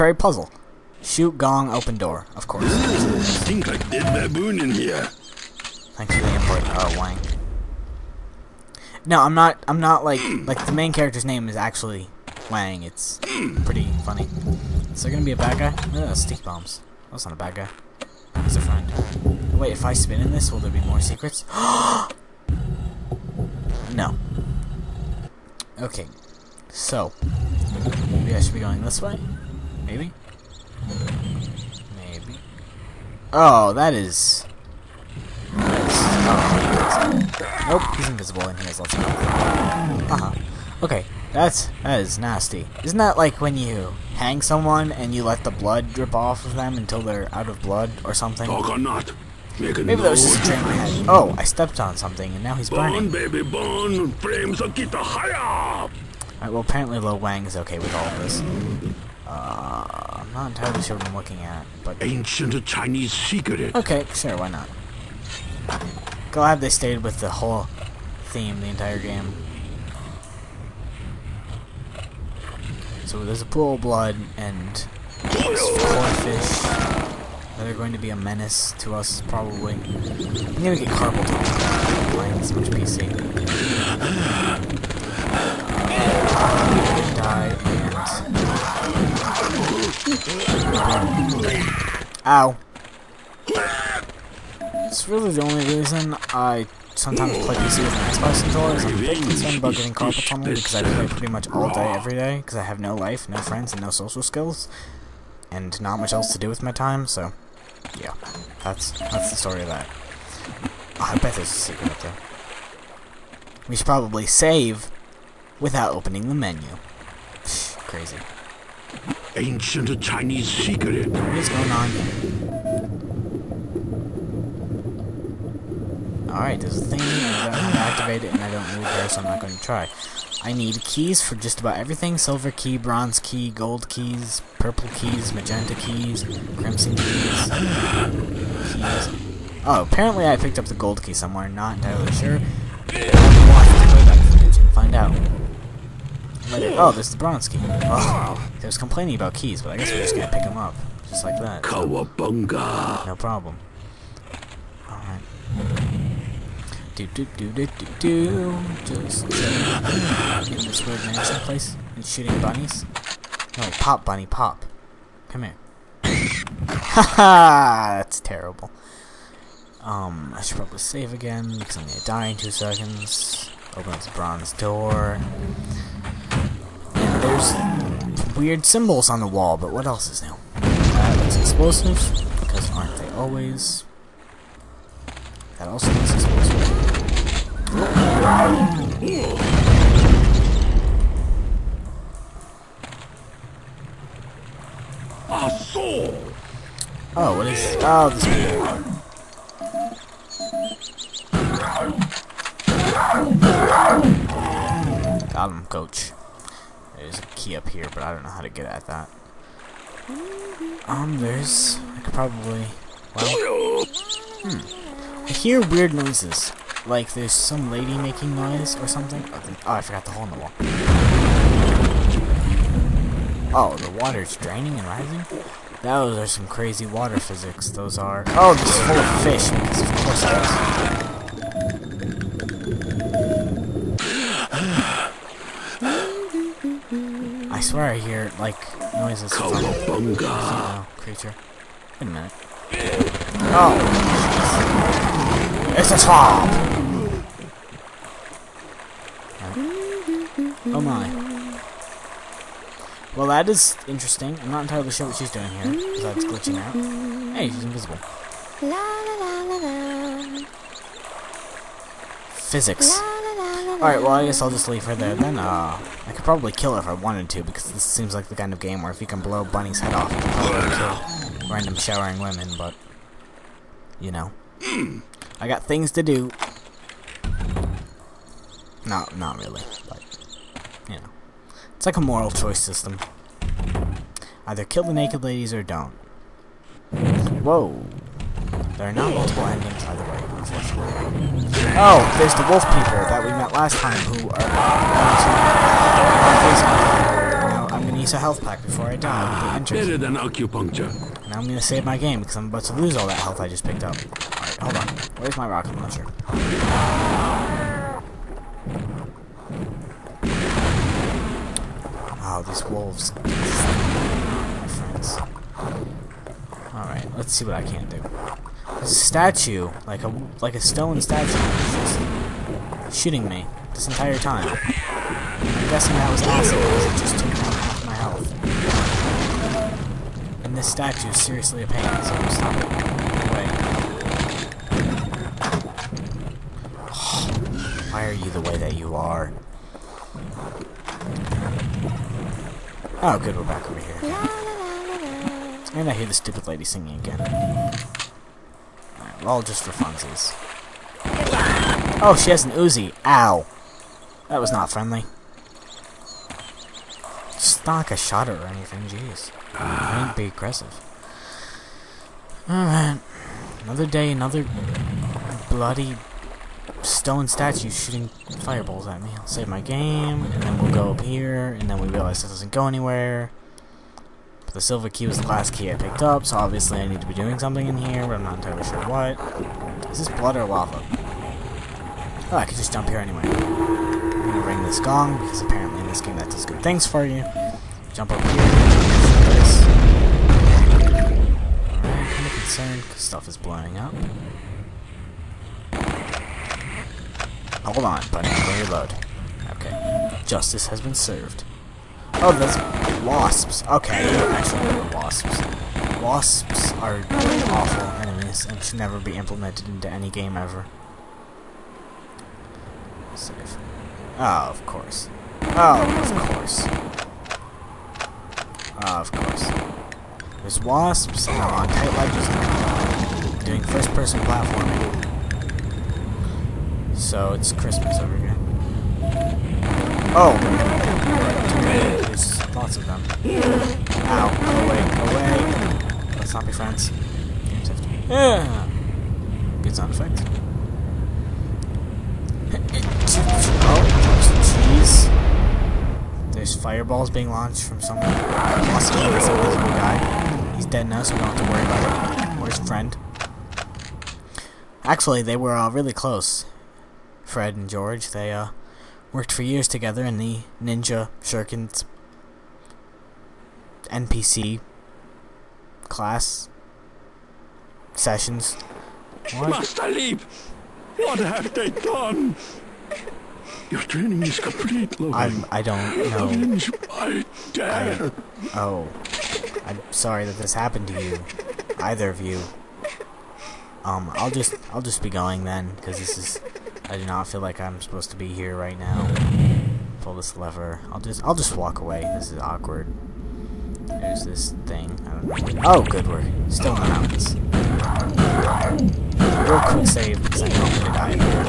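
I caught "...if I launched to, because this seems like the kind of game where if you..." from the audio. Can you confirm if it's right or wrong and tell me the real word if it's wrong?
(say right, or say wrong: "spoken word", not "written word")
wrong: "wanted", not "launched".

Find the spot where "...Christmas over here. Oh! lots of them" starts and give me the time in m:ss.
7:07.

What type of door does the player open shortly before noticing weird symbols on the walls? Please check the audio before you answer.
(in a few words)
Bronze door.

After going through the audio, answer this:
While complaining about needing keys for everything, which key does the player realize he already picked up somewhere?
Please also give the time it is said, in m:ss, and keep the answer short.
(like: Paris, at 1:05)
Gold key, at 2:20.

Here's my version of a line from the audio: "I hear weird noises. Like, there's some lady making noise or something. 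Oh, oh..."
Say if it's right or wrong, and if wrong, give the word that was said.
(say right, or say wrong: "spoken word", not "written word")
right.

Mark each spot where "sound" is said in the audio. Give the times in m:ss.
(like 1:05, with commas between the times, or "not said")
7:19.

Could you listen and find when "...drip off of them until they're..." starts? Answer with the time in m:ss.
0:45.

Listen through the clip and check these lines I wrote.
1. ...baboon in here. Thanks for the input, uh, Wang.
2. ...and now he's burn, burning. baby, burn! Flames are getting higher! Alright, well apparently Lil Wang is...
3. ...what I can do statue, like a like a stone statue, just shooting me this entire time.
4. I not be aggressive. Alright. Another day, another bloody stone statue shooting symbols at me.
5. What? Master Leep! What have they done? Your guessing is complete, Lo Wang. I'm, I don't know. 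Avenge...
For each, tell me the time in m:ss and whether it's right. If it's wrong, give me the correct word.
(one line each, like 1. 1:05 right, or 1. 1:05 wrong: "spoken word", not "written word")
1. 0:04 right
2. 0:52 right
3. 5:17 right
4. 5:59 wrong: "fireballs", not "symbols"
5. 7:49 wrong: "training", not "guessing".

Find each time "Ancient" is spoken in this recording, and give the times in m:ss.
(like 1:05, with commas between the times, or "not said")
1:02, 1:59.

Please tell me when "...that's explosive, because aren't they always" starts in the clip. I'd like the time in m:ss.
3:01.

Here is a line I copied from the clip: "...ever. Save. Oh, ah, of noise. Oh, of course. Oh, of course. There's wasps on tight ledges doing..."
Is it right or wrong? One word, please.
wrong.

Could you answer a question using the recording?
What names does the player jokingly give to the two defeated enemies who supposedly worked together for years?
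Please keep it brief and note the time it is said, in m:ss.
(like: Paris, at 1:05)
Fred and George, at 7:37.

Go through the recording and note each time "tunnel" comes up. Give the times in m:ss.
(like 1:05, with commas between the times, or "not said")
1:21, 1:40.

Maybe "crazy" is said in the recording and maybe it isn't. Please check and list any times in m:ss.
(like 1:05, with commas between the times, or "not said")
1:57, 3:46.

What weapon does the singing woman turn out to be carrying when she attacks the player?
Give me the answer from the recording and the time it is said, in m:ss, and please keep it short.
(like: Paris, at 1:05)
An Uzi, at 5:52.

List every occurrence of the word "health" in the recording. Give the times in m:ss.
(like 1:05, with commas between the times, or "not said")
0:39, 4:58, 5:03, 5:28.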